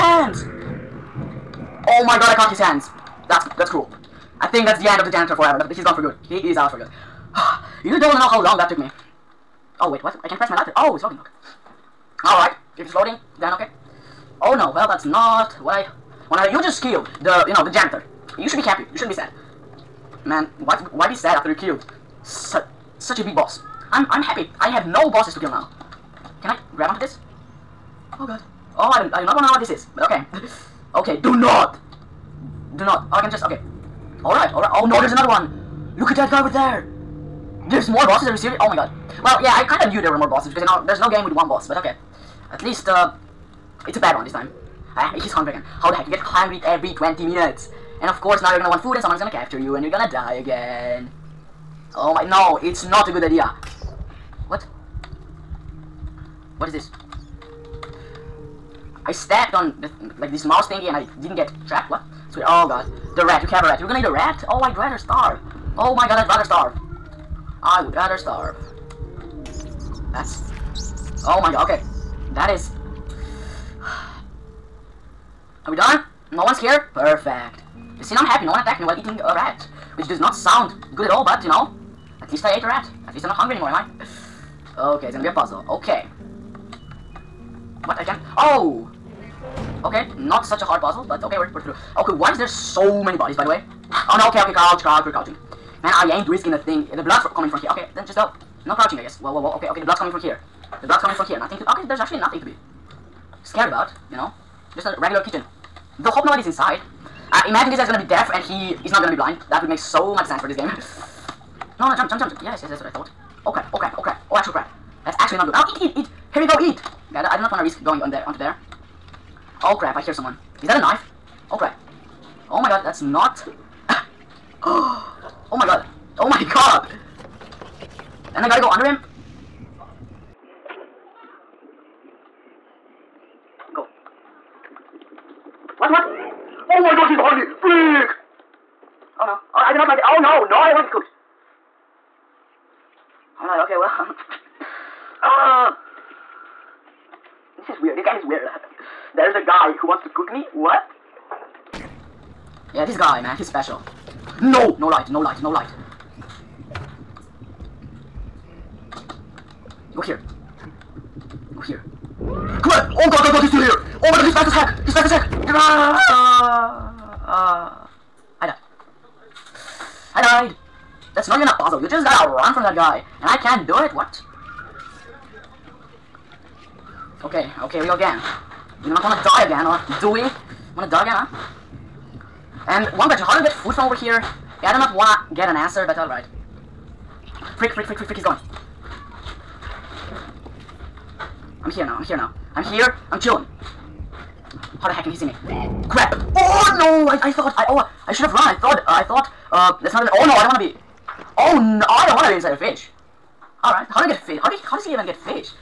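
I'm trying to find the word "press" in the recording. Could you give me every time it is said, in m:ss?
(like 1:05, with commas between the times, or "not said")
0:10.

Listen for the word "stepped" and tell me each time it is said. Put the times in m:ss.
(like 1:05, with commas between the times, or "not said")
0:59.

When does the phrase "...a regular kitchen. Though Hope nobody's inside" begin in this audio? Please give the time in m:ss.
1:44.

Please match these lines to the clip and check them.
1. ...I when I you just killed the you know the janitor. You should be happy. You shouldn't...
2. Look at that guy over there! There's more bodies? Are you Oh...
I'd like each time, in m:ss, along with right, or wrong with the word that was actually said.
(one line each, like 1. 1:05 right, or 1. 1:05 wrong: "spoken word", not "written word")
1. 0:15 right
2. 0:35 wrong: "bosses", not "bodies".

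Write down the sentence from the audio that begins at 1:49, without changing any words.
That would make so much sense for this game.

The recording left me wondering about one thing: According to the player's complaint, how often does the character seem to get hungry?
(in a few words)
Every 20 minutes.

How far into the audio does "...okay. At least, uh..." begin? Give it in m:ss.
0:41.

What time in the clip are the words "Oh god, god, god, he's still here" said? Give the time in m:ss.
2:42.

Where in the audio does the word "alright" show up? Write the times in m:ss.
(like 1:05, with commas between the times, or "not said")
0:12, 3:05.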